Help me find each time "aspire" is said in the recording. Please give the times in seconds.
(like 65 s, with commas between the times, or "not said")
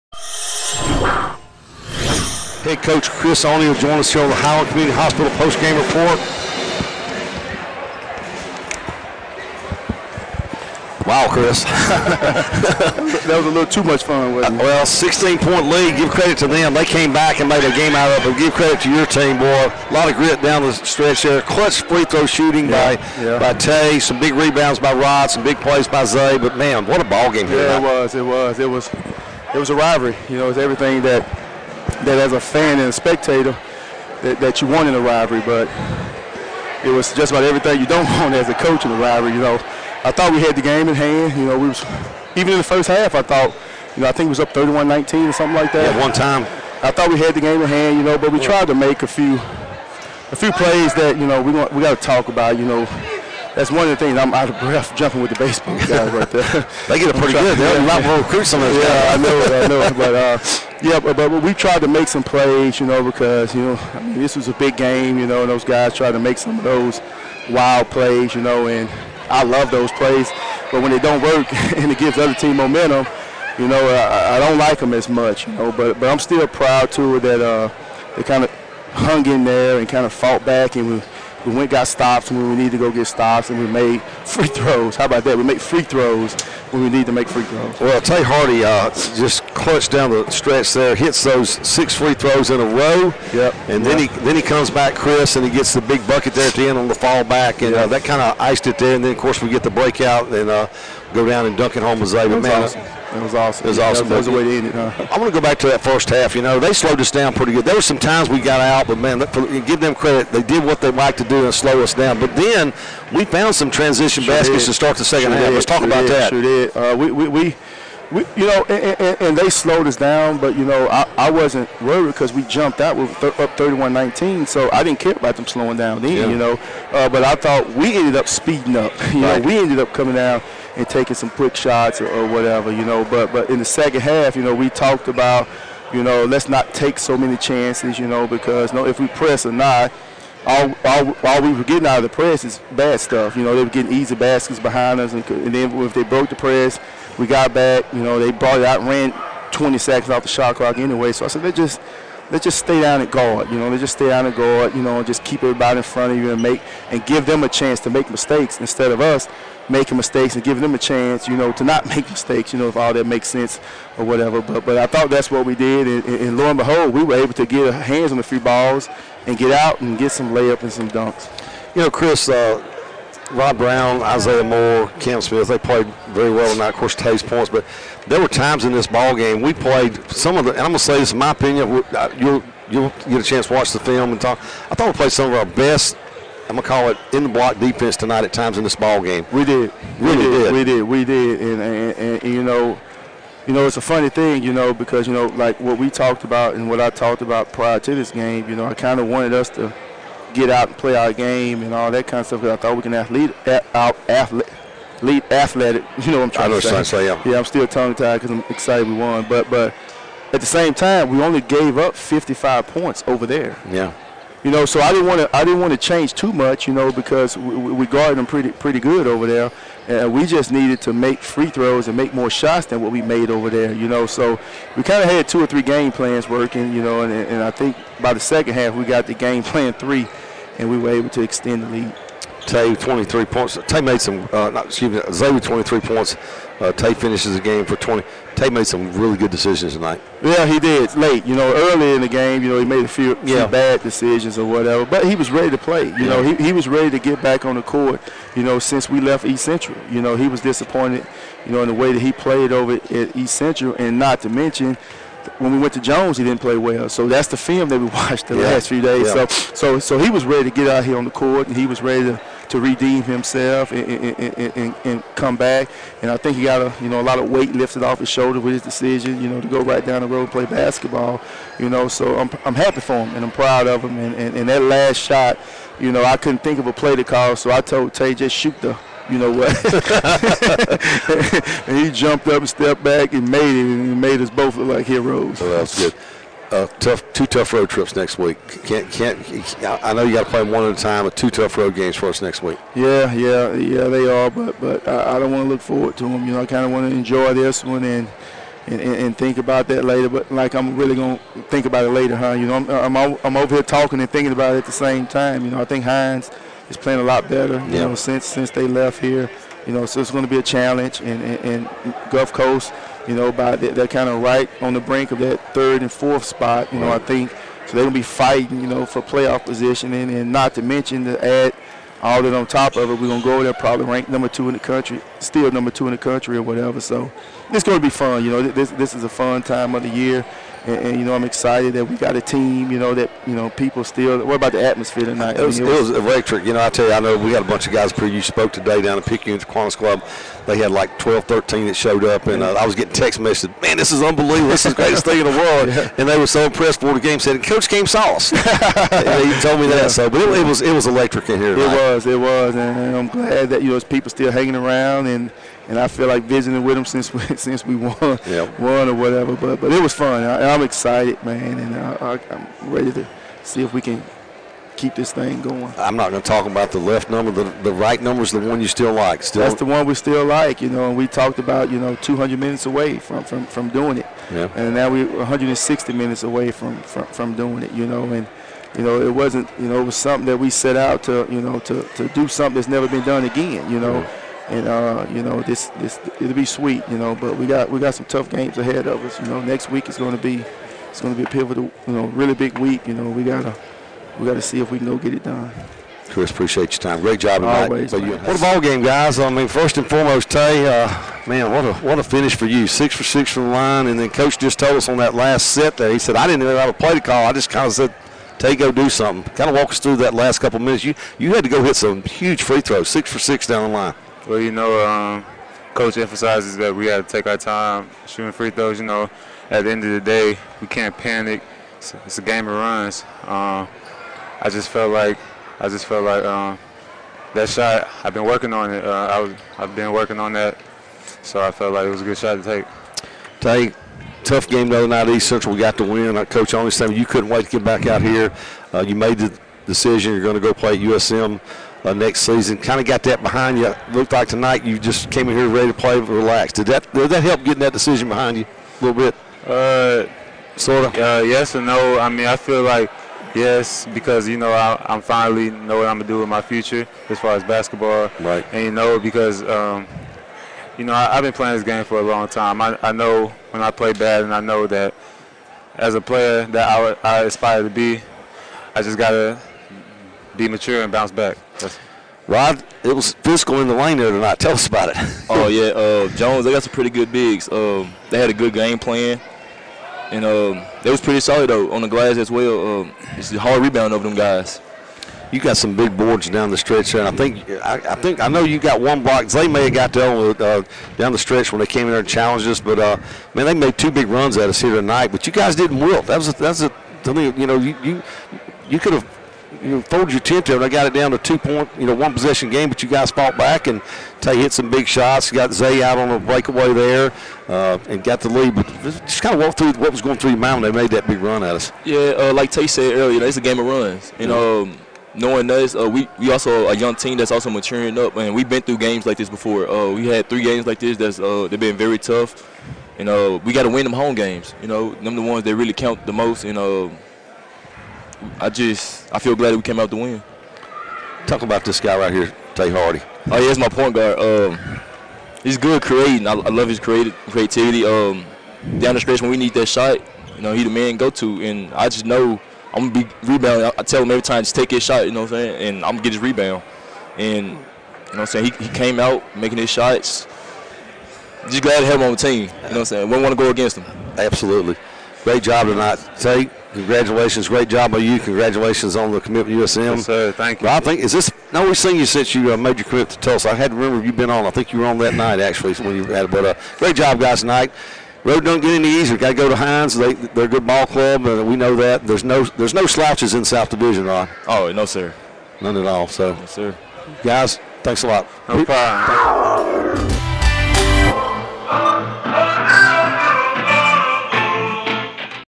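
467 s.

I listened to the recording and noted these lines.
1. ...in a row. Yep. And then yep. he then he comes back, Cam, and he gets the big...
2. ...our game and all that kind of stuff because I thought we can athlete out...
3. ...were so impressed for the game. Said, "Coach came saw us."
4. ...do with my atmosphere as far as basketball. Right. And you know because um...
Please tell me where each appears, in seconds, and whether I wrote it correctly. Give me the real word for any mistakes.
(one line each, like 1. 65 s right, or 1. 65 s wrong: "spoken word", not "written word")
1. 92 s wrong: "Chris", not "Cam"
2. 200 s right
3. 346 s right
4. 456 s wrong: "future", not "atmosphere".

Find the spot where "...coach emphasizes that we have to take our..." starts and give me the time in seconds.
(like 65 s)
415 s.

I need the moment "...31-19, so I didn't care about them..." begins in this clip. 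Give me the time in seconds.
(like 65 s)
123 s.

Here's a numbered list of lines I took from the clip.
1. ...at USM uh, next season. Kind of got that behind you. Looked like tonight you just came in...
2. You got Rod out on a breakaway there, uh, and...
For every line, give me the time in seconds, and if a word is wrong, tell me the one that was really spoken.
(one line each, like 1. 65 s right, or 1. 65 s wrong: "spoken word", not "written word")
1. 440 s right
2. 505 s wrong: "Zay", not "Rod".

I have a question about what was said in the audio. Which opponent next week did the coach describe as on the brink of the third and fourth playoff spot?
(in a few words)
Gulf Coast.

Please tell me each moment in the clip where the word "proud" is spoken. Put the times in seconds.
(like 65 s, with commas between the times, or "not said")
76 s, 273 s.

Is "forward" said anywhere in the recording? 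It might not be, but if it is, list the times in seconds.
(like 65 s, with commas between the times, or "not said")
295 s.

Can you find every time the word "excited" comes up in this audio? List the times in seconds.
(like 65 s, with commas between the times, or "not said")
208 s, 331 s, 360 s.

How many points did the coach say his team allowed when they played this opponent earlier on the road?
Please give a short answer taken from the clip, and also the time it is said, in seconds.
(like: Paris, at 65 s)
55, at 211 s.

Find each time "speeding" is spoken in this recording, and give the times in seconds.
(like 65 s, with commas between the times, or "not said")
128 s.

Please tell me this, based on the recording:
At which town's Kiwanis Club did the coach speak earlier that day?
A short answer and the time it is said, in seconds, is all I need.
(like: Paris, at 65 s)
Picayune, at 339 s.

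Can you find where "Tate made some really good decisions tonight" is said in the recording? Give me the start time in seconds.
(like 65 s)
238 s.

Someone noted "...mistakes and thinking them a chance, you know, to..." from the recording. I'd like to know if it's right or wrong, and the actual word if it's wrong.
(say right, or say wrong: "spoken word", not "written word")
wrong: "giving", not "thinking".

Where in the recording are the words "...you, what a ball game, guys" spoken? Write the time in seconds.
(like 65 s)
397 s.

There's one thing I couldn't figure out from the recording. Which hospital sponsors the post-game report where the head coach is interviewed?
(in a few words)
Howard Community Hospital.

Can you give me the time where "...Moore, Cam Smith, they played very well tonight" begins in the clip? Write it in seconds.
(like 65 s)
174 s.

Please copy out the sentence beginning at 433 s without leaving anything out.
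Take tough game the other night East Central.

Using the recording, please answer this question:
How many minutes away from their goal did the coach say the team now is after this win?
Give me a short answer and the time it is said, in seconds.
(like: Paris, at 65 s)
160, at 375 s.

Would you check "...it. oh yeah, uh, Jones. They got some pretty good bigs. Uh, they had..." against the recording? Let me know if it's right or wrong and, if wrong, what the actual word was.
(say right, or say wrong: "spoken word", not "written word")
right.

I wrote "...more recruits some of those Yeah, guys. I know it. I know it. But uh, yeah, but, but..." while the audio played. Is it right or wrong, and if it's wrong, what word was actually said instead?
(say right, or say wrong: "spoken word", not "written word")
right.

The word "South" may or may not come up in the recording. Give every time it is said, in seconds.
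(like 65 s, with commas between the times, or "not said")
573 s.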